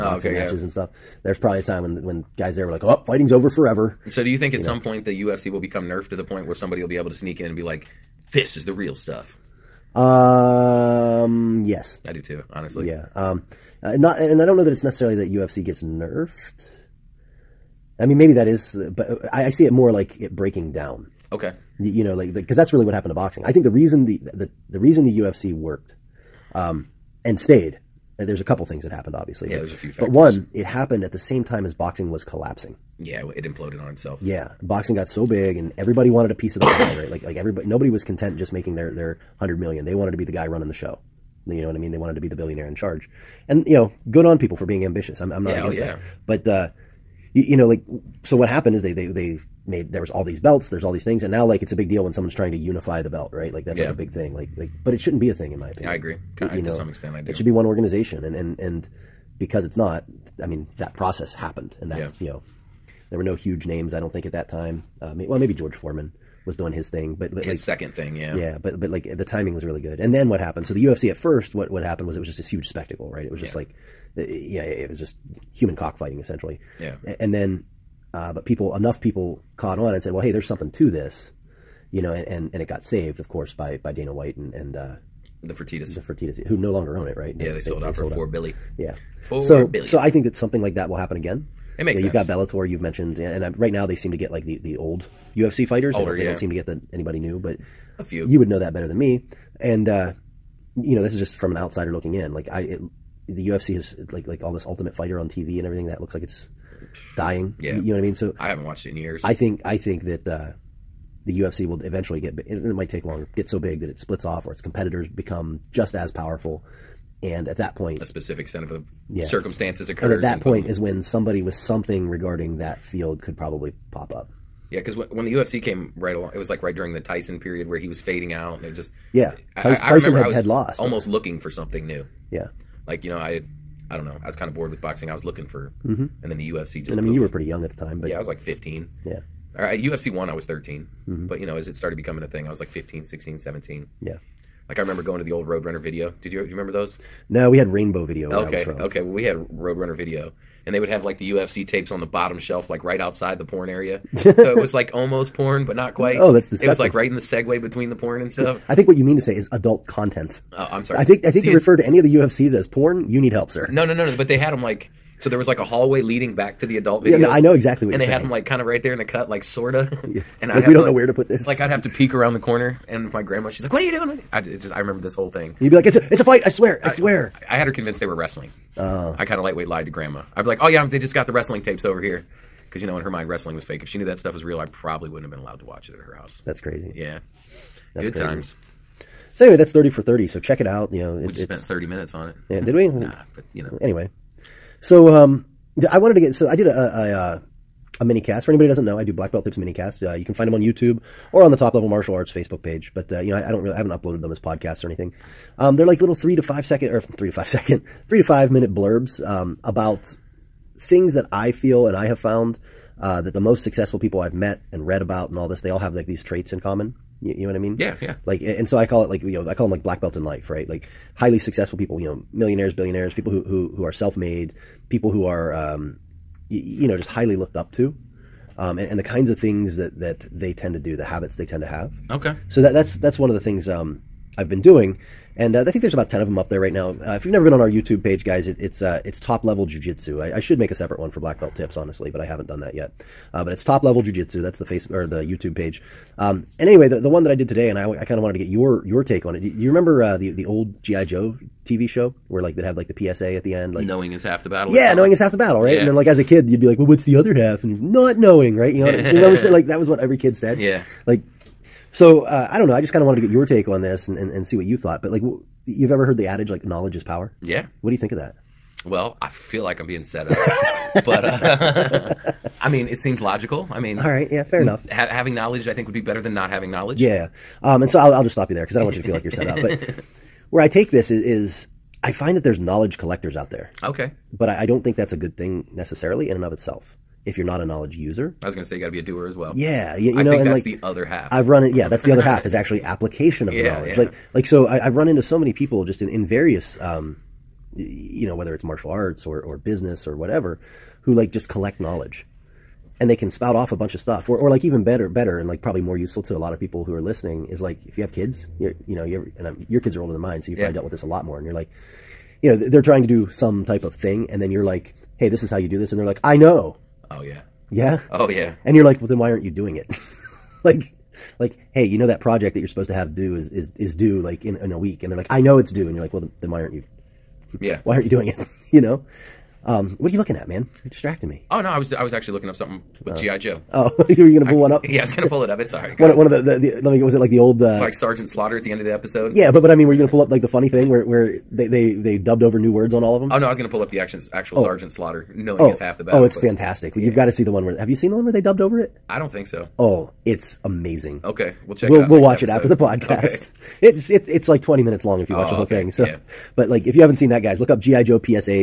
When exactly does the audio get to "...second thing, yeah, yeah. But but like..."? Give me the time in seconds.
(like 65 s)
67 s.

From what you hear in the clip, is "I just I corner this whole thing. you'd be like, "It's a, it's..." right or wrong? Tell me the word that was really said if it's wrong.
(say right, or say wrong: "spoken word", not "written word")
wrong: "remember", not "corner".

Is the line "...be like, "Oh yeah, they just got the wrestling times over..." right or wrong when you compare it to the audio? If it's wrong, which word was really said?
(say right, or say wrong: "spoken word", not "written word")
wrong: "tapes", not "times".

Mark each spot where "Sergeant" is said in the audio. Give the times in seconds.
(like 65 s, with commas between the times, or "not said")
337 s, 344 s.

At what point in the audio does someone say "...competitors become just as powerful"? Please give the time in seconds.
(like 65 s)
114 s.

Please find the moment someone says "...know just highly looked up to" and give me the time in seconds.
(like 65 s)
226 s.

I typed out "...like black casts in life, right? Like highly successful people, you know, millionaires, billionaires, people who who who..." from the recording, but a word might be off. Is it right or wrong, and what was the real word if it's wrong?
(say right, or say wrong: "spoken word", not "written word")
wrong: "belts", not "casts".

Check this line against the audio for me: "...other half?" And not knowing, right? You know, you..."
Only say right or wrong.
right.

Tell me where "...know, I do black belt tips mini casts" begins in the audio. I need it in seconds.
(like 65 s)
198 s.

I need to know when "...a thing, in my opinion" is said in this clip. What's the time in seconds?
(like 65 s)
55 s.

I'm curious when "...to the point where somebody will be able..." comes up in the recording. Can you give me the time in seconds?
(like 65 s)
6 s.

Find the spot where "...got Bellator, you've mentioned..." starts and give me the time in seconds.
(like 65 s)
92 s.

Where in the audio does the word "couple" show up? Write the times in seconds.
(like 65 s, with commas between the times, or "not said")
28 s.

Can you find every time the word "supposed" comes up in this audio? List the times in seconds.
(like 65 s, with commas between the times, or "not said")
322 s.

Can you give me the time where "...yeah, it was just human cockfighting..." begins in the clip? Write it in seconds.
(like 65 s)
74 s.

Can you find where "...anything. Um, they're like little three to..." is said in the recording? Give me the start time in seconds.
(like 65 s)
204 s.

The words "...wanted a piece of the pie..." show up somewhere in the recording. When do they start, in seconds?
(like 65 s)
36 s.